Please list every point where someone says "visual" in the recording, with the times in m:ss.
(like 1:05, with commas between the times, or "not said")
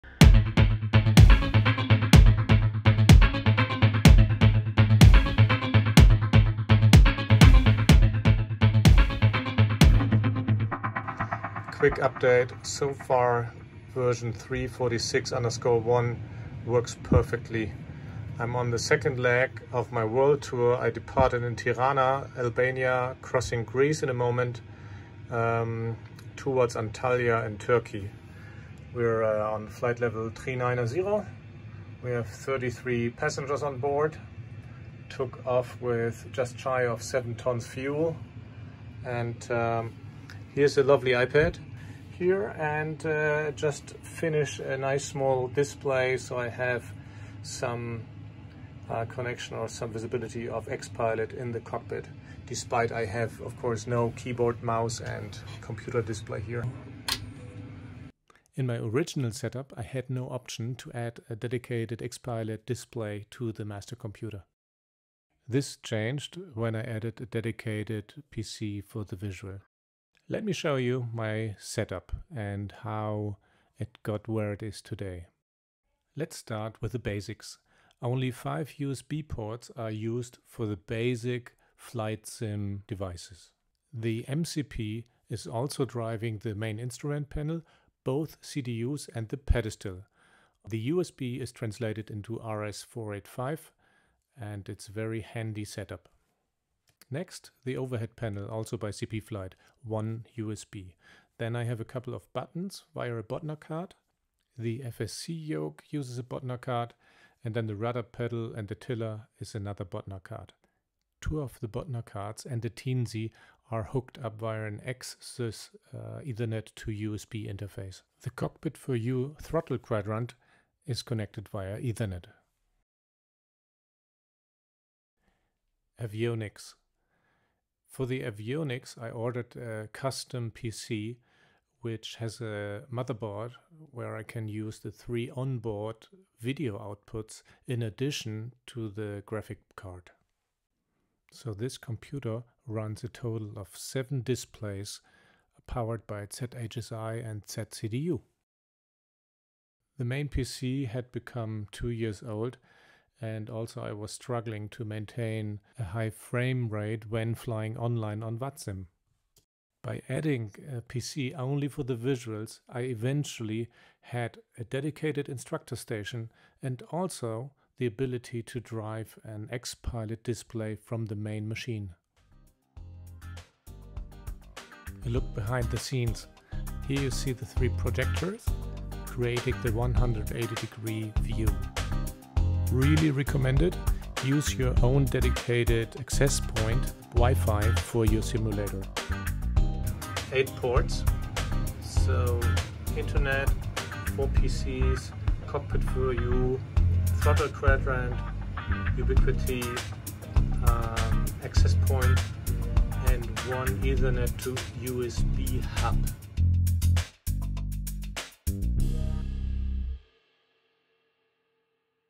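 1:09, 2:41.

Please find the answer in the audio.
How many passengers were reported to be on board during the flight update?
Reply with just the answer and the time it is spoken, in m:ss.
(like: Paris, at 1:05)
33, at 0:32.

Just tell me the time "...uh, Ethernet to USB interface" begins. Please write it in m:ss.
1:55.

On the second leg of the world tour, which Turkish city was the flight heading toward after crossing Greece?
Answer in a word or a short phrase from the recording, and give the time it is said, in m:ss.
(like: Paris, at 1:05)
Antalya, at 0:26.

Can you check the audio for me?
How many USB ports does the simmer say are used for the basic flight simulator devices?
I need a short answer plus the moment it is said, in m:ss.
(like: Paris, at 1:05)
5, at 1:18.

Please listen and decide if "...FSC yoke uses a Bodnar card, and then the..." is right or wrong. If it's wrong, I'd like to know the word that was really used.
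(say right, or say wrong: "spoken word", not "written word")
right.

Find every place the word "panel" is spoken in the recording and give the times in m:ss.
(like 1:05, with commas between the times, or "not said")
1:27, 1:38.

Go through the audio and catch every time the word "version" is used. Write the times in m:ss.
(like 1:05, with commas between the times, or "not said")
0:13.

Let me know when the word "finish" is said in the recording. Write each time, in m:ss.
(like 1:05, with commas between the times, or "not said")
0:44.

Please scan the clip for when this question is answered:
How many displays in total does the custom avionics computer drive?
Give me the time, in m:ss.
2:23.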